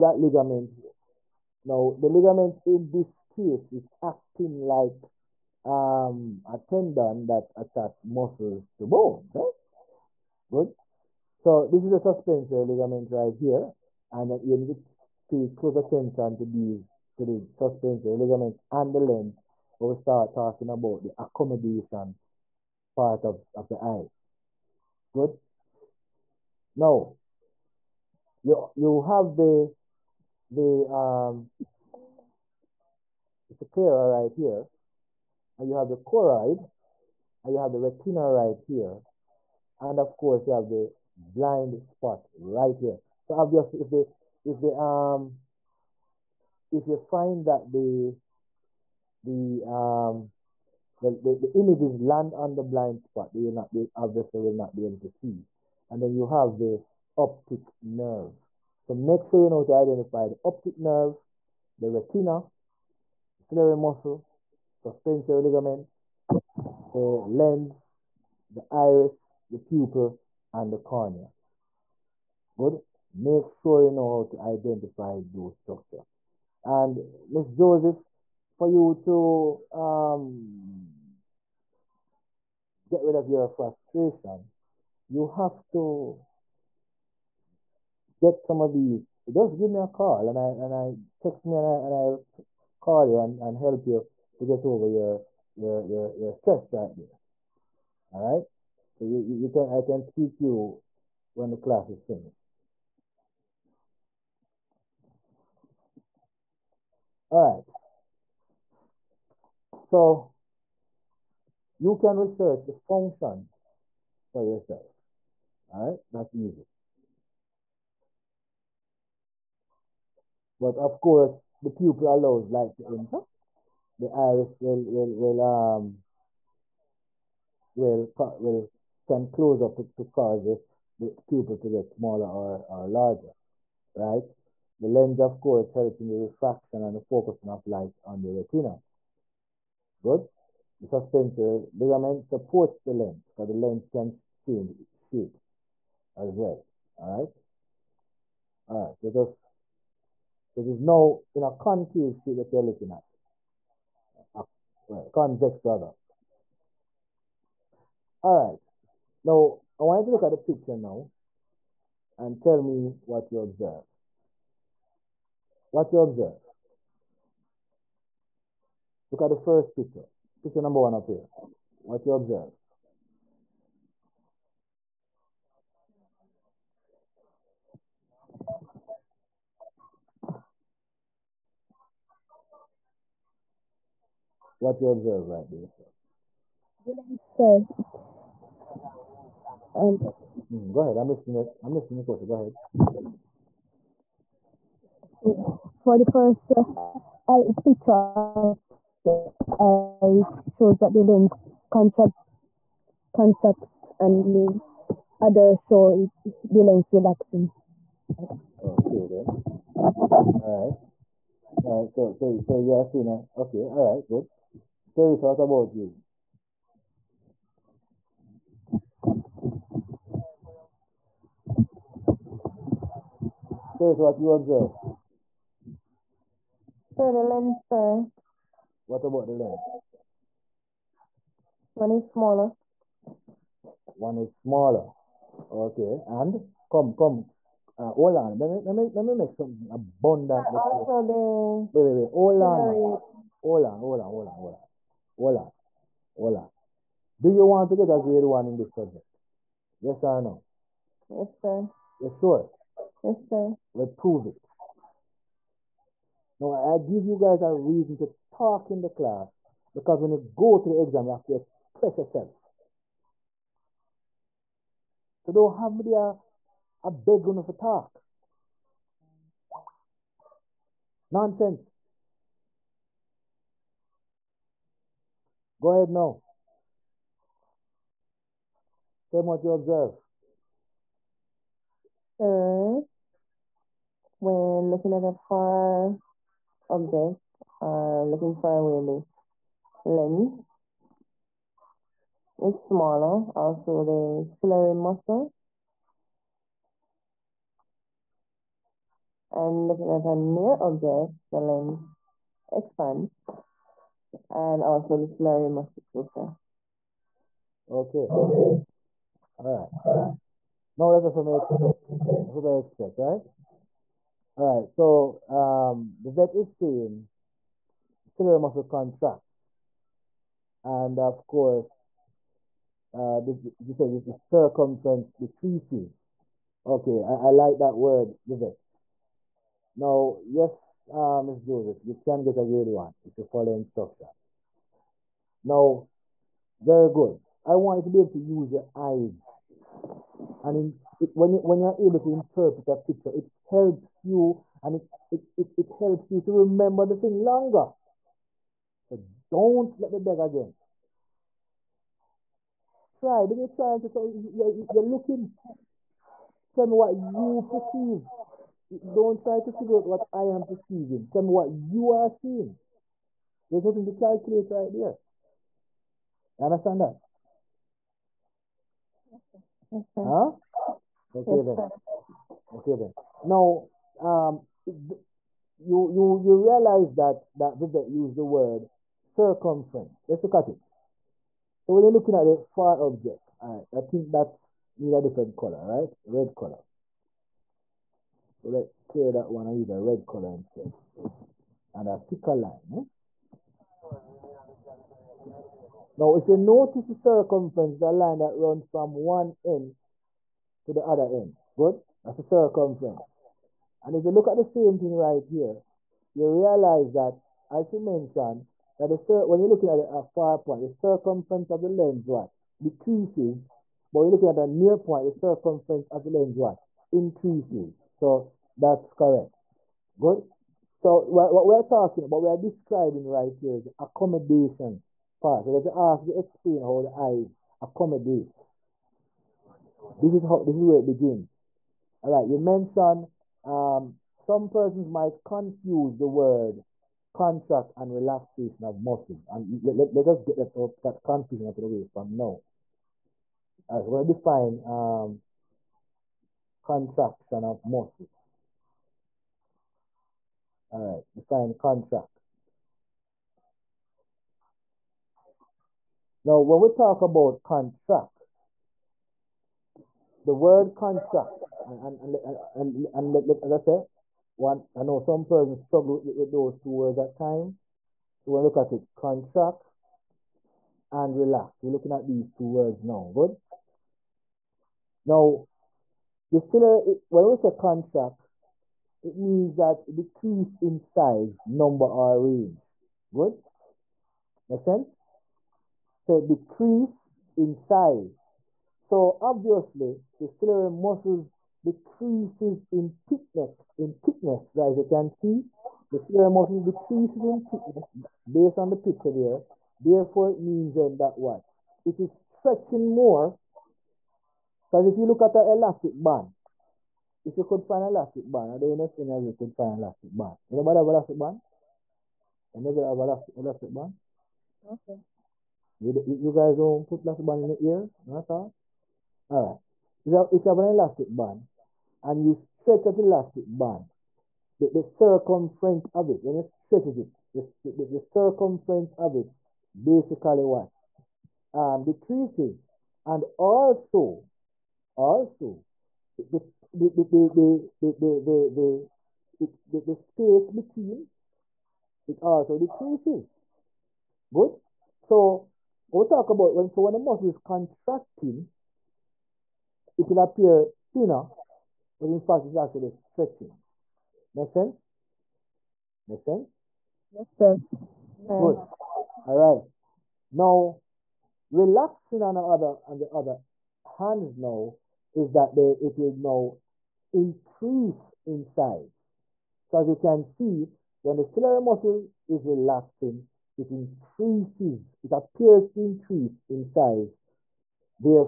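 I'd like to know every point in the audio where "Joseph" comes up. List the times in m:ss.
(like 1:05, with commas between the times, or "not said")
1:17, 5:31.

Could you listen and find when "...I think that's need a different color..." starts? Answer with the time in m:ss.
6:23.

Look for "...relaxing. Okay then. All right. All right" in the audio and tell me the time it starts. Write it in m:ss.
3:26.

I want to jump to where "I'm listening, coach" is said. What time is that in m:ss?
3:11.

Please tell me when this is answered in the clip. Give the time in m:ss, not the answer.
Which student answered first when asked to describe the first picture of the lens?
3:06.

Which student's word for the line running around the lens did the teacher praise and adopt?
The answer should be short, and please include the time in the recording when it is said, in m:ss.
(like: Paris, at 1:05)
Vivek, at 6:17.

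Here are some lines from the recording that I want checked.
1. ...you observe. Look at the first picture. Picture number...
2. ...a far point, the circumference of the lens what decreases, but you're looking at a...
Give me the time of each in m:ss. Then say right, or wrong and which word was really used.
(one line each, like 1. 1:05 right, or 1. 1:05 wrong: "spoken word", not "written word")
1. 2:45 right
2. 6:49 right.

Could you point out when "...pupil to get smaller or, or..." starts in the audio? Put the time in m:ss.
2:11.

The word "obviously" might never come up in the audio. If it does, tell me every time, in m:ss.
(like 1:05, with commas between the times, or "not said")
0:43, 0:53, 8:09.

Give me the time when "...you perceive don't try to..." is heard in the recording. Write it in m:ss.
5:56.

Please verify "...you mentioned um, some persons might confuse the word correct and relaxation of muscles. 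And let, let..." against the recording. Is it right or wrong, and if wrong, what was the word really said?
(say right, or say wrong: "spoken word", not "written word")
wrong: "contract", not "correct".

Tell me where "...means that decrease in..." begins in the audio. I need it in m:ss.
7:59.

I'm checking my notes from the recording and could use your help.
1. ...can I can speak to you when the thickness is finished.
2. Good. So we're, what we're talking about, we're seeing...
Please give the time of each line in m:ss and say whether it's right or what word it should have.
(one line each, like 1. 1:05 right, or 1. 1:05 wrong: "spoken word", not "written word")
1. 1:39 wrong: "class", not "thickness"
2. 6:59 wrong: "describing", not "seeing".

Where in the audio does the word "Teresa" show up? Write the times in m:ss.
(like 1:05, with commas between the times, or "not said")
3:34, 3:43.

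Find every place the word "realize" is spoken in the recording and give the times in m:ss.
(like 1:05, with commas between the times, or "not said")
6:16, 6:46.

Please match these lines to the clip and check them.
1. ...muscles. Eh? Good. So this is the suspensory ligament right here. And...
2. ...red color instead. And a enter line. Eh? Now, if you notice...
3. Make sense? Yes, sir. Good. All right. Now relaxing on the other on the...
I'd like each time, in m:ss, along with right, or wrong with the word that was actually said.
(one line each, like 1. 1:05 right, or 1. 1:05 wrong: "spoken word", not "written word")
1. 0:08 wrong: "bones", not "muscles"
2. 6:29 wrong: "thicker", not "enter"
3. 9:16 right.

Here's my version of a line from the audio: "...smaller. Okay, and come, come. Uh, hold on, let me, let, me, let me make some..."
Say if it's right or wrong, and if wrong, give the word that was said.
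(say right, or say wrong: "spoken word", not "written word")
right.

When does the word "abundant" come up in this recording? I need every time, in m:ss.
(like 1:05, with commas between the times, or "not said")
3:59.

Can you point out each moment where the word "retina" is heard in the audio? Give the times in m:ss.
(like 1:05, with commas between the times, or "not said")
0:37, 1:01, 2:18.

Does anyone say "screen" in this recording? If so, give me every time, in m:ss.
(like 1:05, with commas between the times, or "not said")
not said.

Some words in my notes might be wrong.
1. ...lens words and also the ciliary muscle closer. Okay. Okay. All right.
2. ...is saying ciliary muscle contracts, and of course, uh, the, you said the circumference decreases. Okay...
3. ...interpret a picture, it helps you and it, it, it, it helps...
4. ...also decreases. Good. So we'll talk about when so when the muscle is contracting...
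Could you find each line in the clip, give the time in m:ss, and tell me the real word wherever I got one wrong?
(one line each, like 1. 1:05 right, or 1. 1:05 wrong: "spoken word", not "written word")
1. 5:01 wrong: "expands", not "words"
2. 5:16 right
3. 5:42 right
4. 9:02 right.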